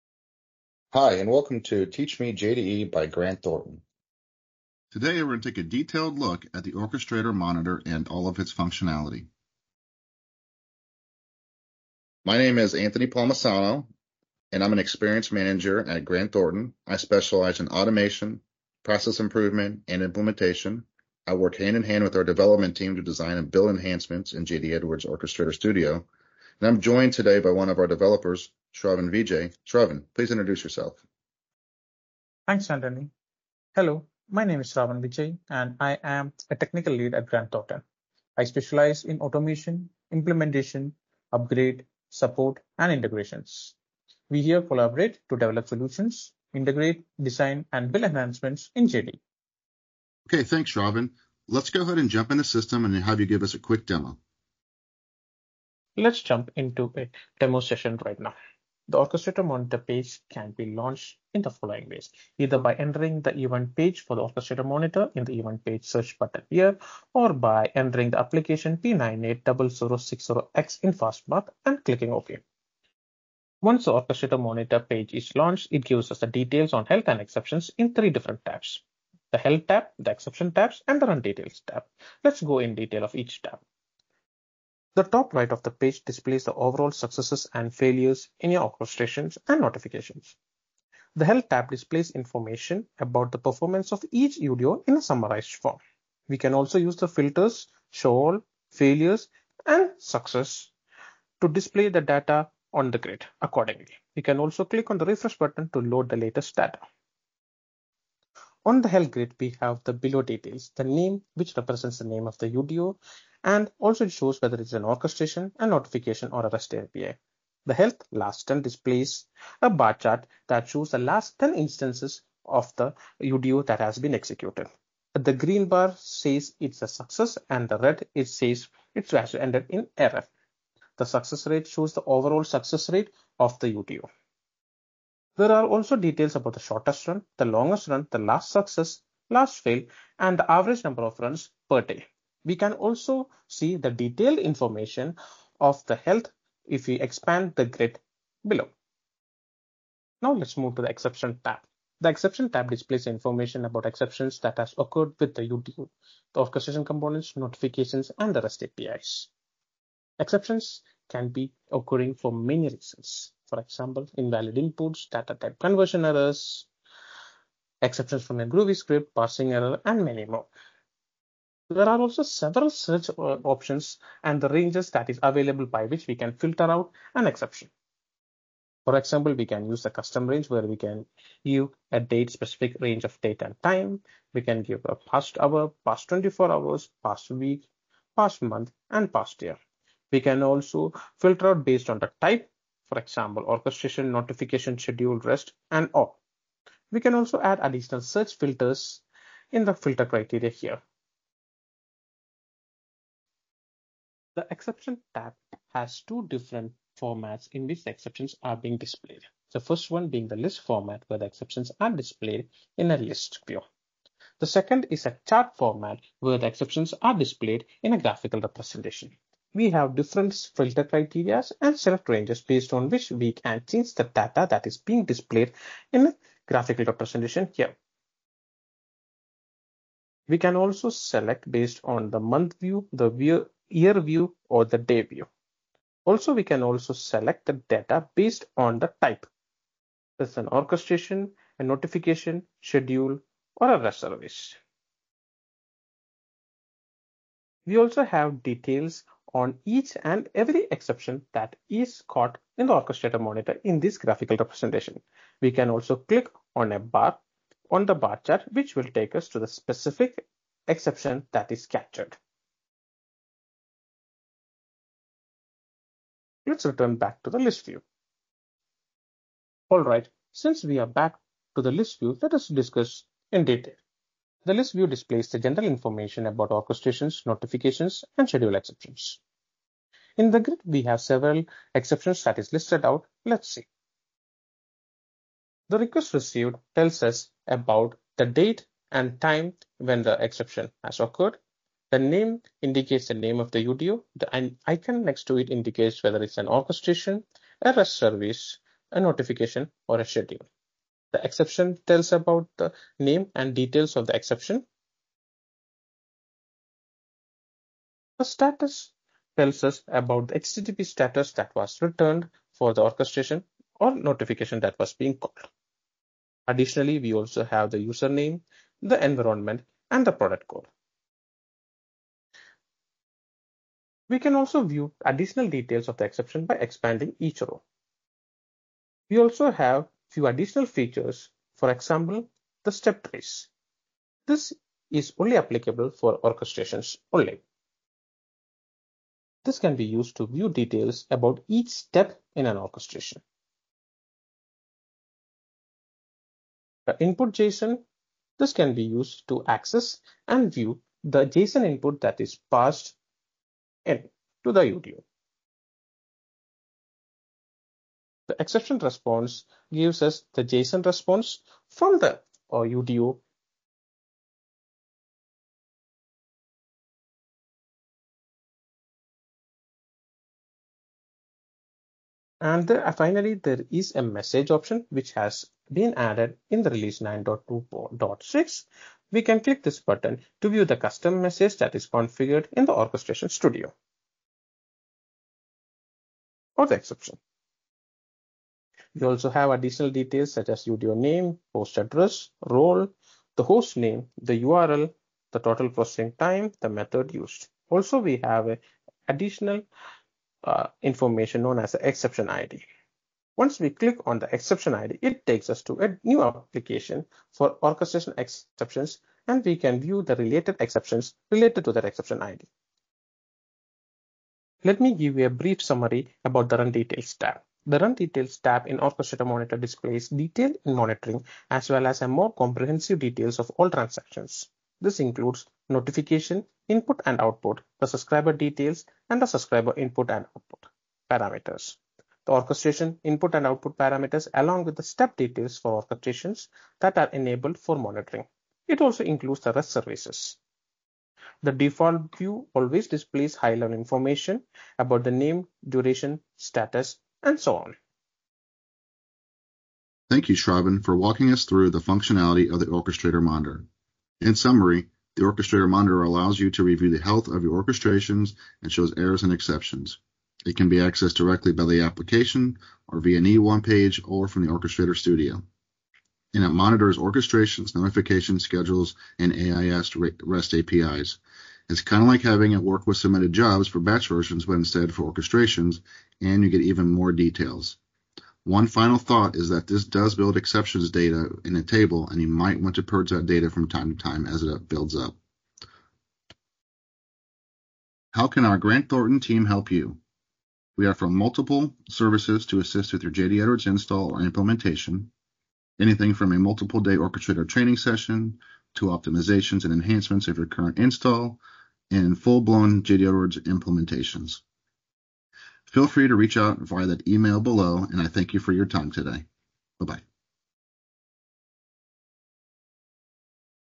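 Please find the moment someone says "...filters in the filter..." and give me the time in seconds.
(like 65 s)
198 s.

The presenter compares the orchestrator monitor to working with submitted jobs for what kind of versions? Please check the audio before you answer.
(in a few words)
Batch versions.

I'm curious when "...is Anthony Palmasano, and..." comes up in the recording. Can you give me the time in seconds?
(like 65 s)
12 s.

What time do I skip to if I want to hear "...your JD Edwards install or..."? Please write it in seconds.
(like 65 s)
493 s.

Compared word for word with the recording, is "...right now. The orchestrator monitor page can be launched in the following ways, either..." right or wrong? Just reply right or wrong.
right.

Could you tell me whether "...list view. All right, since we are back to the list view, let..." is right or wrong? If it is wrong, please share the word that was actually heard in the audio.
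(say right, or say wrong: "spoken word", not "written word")
right.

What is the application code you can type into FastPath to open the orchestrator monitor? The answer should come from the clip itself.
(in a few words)
P980060X.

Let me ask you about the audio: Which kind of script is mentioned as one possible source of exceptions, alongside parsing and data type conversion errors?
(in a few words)
Groovy.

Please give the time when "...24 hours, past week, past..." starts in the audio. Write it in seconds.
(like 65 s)
186 s.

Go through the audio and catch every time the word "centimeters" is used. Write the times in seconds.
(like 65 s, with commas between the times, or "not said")
not said.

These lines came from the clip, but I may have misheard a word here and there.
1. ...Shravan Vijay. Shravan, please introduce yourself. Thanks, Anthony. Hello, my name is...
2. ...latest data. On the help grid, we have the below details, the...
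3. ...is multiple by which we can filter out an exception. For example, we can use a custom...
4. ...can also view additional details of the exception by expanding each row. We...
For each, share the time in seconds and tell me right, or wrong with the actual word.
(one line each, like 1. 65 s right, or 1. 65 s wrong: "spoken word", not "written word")
1. 28 s right
2. 106 s right
3. 175 s wrong: "available", not "multiple"
4. 324 s right.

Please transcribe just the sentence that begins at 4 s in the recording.
Today, we're going to take a detailed look at the orchestrator monitor and all of its functionality.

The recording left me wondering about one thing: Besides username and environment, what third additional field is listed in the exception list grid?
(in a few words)
Product code.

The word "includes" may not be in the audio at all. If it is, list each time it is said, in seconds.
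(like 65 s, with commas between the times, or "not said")
424 s, 439 s.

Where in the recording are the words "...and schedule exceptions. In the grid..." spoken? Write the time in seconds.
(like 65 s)
278 s.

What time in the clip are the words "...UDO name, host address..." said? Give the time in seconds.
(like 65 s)
390 s.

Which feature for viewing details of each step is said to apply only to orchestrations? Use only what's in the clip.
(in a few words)
Step trace.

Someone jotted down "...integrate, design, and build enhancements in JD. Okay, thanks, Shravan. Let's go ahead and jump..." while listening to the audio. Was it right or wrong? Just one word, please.
right.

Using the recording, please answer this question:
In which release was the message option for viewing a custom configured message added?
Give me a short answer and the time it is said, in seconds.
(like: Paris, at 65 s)
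9.2.6, at 377 s.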